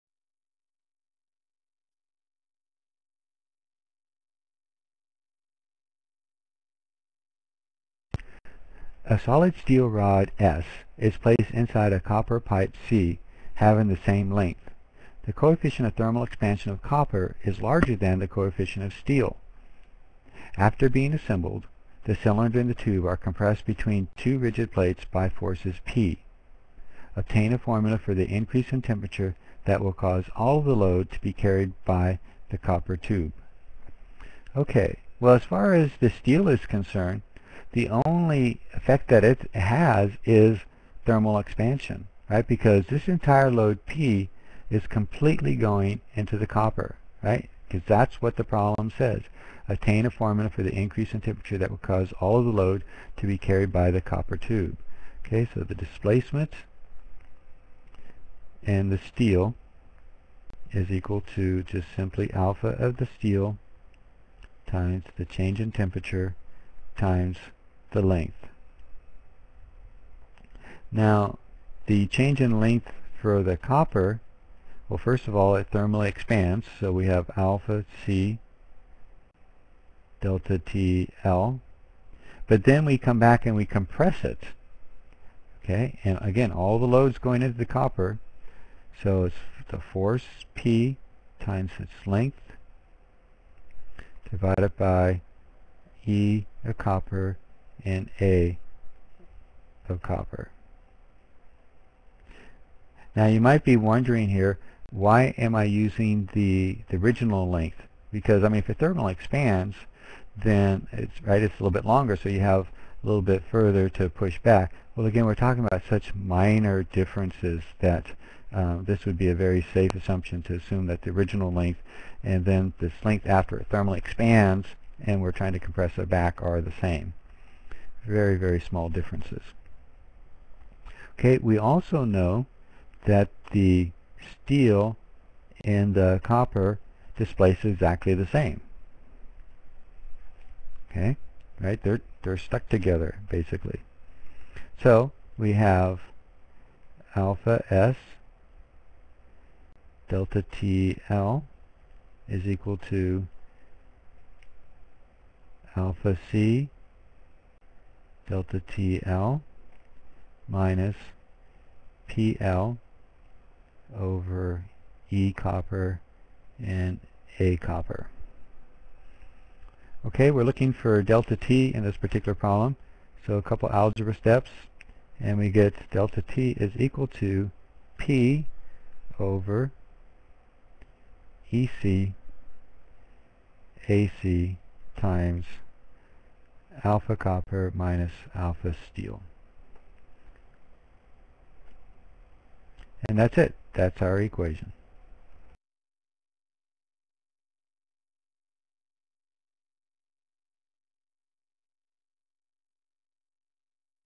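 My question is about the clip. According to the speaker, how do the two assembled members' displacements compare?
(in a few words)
Exactly the same.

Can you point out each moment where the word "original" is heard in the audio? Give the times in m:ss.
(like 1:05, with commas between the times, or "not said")
1:46, 2:01.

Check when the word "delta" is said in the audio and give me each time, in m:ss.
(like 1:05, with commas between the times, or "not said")
1:20, 2:30, 2:38, 2:51, 2:55.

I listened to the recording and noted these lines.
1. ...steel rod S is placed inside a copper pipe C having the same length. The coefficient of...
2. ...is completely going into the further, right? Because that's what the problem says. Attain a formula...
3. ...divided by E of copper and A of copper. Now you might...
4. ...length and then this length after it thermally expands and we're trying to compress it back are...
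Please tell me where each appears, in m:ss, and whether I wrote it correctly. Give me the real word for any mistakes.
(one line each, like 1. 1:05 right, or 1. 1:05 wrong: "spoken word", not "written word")
1. 0:09 right
2. 0:44 wrong: "copper", not "further"
3. 1:34 right
4. 2:01 right.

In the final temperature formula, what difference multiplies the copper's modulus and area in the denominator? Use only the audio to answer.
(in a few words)
Alpha copper minus alpha steel.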